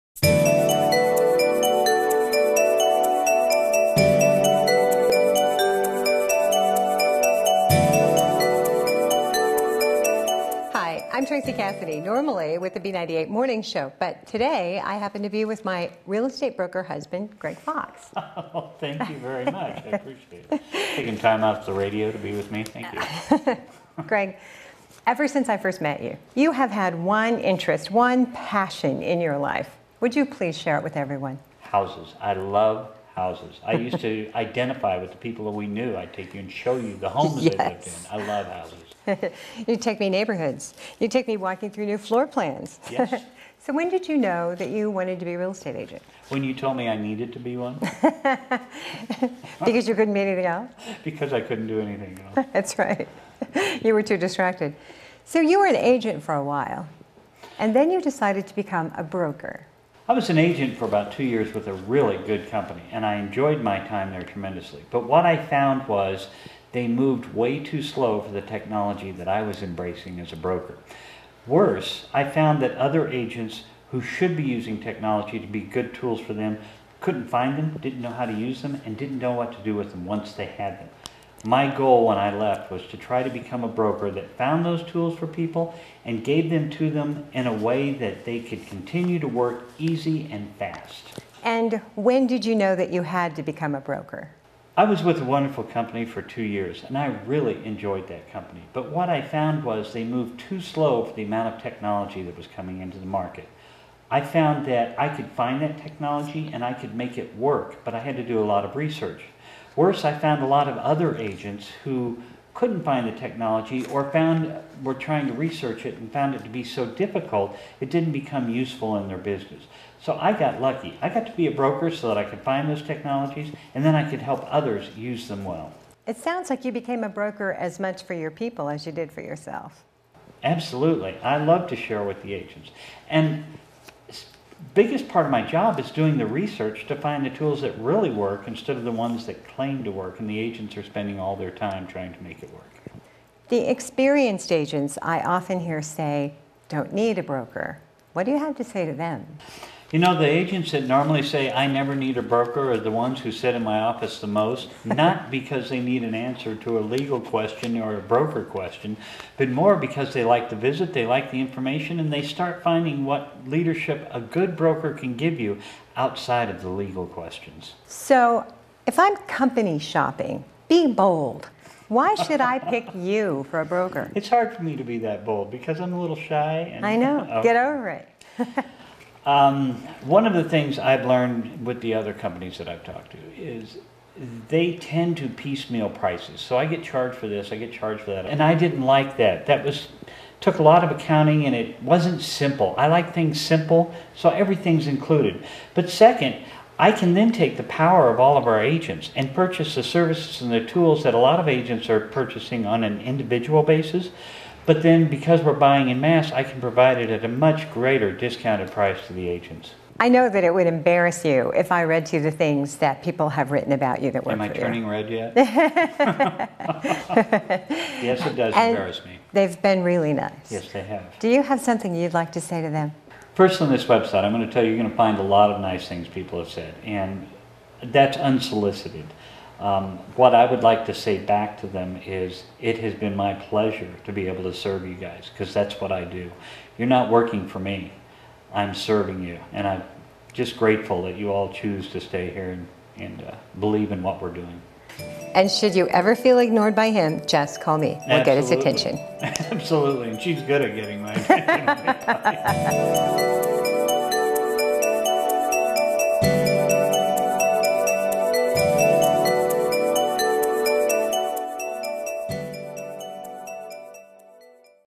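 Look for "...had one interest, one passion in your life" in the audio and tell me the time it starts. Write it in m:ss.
0:26.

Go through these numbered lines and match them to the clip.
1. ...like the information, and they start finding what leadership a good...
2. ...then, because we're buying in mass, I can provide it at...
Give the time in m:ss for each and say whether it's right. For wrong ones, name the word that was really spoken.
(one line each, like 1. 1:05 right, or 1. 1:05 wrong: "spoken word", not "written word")
1. 2:41 right
2. 3:24 right.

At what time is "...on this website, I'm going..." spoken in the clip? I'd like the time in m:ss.
3:43.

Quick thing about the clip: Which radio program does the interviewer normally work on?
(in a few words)
B98 Morning Show.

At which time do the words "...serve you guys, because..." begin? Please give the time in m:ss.
3:54.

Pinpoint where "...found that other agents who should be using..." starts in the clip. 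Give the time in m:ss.
1:12.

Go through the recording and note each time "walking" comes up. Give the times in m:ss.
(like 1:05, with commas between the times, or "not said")
0:41.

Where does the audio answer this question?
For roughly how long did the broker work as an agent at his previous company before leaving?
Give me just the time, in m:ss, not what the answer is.
1:00.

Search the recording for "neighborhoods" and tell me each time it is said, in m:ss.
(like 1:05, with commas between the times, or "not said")
0:40.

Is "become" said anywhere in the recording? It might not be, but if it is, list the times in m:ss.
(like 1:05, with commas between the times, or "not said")
0:58, 1:23, 1:33, 1:58.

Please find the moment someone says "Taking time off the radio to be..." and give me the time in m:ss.
0:20.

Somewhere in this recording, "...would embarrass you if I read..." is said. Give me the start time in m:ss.
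3:30.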